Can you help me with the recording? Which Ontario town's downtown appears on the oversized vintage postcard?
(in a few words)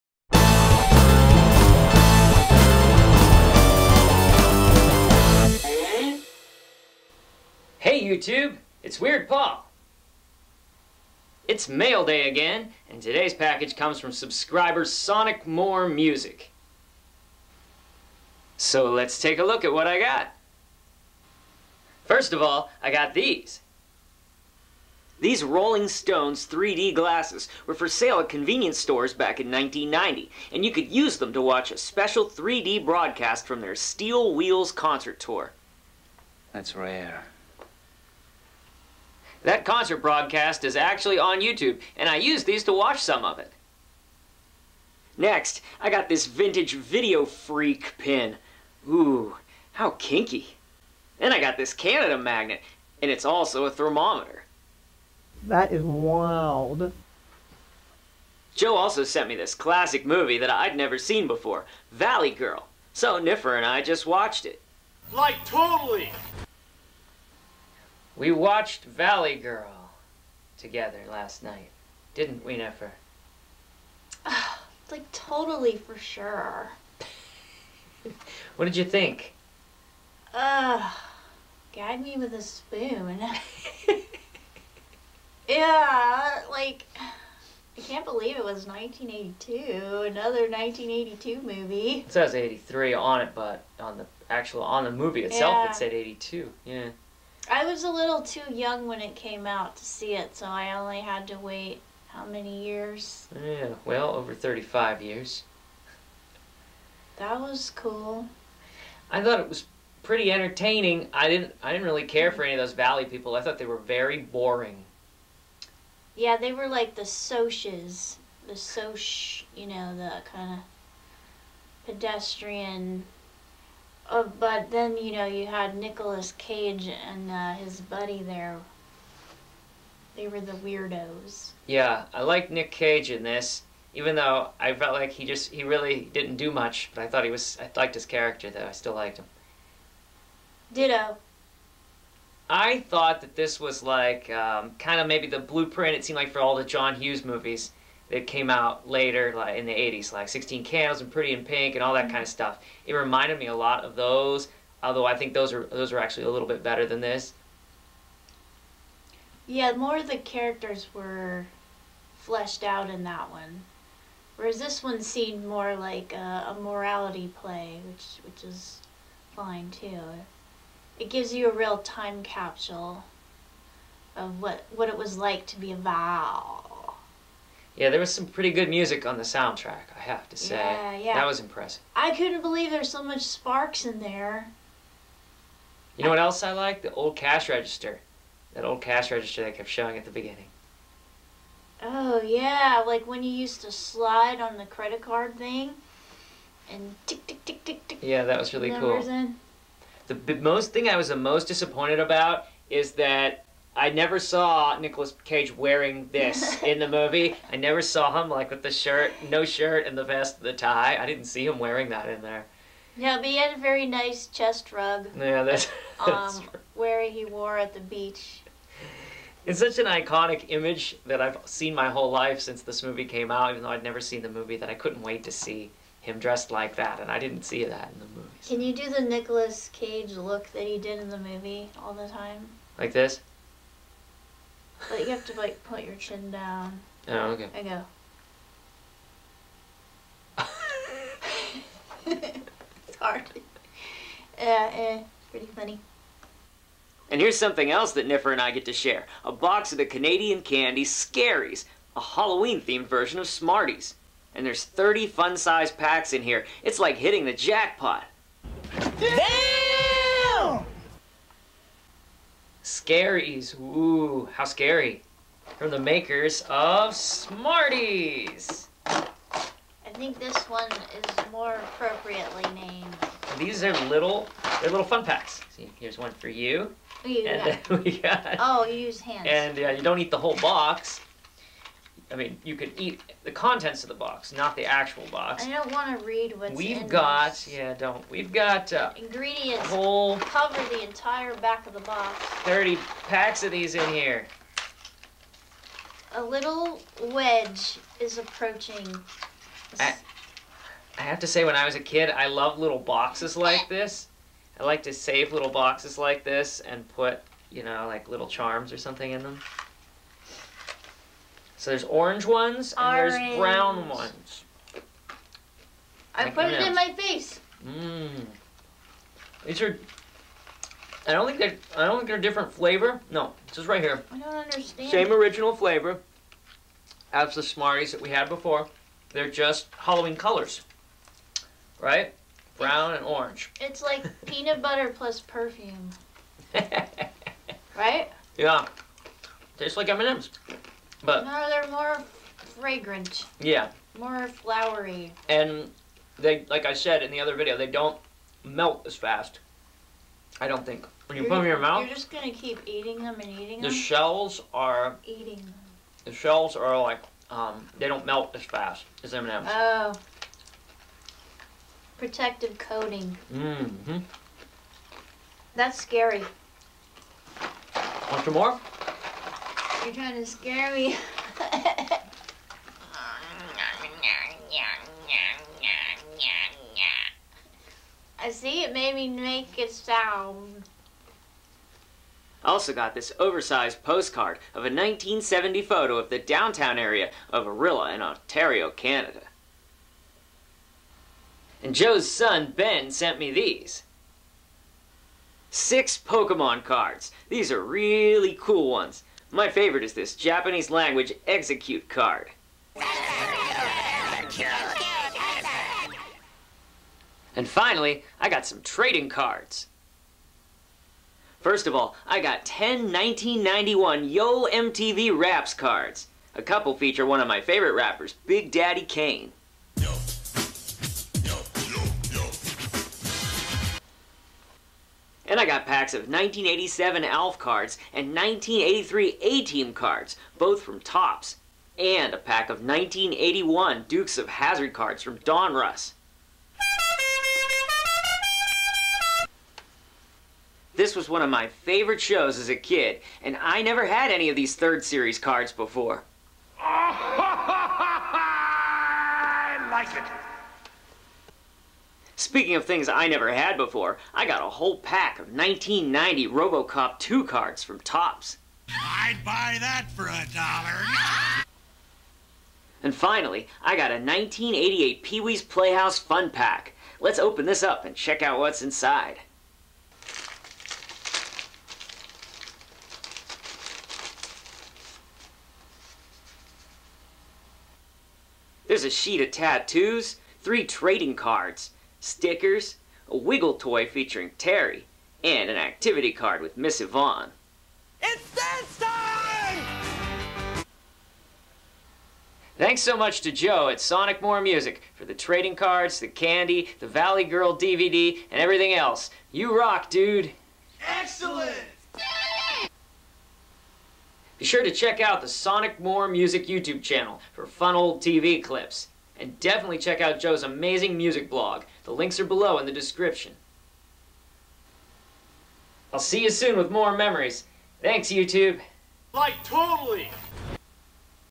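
Orillia.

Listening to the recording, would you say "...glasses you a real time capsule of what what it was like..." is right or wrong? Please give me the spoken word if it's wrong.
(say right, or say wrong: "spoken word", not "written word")
wrong: "gives", not "glasses".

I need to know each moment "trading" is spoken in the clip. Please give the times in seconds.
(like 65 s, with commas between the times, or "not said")
408 s, 480 s, 495 s.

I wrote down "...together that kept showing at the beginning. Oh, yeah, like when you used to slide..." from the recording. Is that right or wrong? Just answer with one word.
wrong.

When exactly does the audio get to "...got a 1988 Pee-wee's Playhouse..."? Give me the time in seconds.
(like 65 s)
463 s.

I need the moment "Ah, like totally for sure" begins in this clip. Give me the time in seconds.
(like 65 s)
74 s.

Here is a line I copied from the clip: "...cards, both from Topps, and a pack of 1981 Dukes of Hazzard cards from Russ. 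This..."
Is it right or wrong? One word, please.
right.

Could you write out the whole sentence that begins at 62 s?
So Niffer and I just watched it.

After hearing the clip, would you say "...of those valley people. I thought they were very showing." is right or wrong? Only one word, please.
wrong.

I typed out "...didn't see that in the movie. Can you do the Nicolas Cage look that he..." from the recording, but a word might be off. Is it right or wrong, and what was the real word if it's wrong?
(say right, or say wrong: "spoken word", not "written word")
right.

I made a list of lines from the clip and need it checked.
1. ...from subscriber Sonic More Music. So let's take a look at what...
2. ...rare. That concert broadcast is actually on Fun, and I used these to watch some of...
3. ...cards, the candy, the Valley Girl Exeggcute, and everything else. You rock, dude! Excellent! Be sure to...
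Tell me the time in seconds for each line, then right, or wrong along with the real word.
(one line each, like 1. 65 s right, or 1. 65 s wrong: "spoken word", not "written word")
1. 14 s right
2. 36 s wrong: "YouTube", not "Fun"
3. 495 s wrong: "DVD", not "Exeggcute".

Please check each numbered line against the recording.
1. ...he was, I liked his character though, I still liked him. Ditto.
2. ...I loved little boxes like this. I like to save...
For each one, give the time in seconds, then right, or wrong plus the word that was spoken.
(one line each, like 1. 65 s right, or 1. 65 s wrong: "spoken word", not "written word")
1. 137 s right
2. 302 s right.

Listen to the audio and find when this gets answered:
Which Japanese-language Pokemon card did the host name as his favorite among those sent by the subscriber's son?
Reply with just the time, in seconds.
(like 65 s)
401 s.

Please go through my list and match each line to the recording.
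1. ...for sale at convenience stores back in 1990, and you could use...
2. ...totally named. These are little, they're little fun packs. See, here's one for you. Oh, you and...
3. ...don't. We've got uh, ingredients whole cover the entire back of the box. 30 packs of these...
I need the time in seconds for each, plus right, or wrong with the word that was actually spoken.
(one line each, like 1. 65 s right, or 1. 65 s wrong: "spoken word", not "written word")
1. 27 s right
2. 271 s wrong: "appropriately", not "totally"
3. 287 s right.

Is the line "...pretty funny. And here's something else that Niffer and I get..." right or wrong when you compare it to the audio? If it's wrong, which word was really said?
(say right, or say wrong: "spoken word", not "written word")
right.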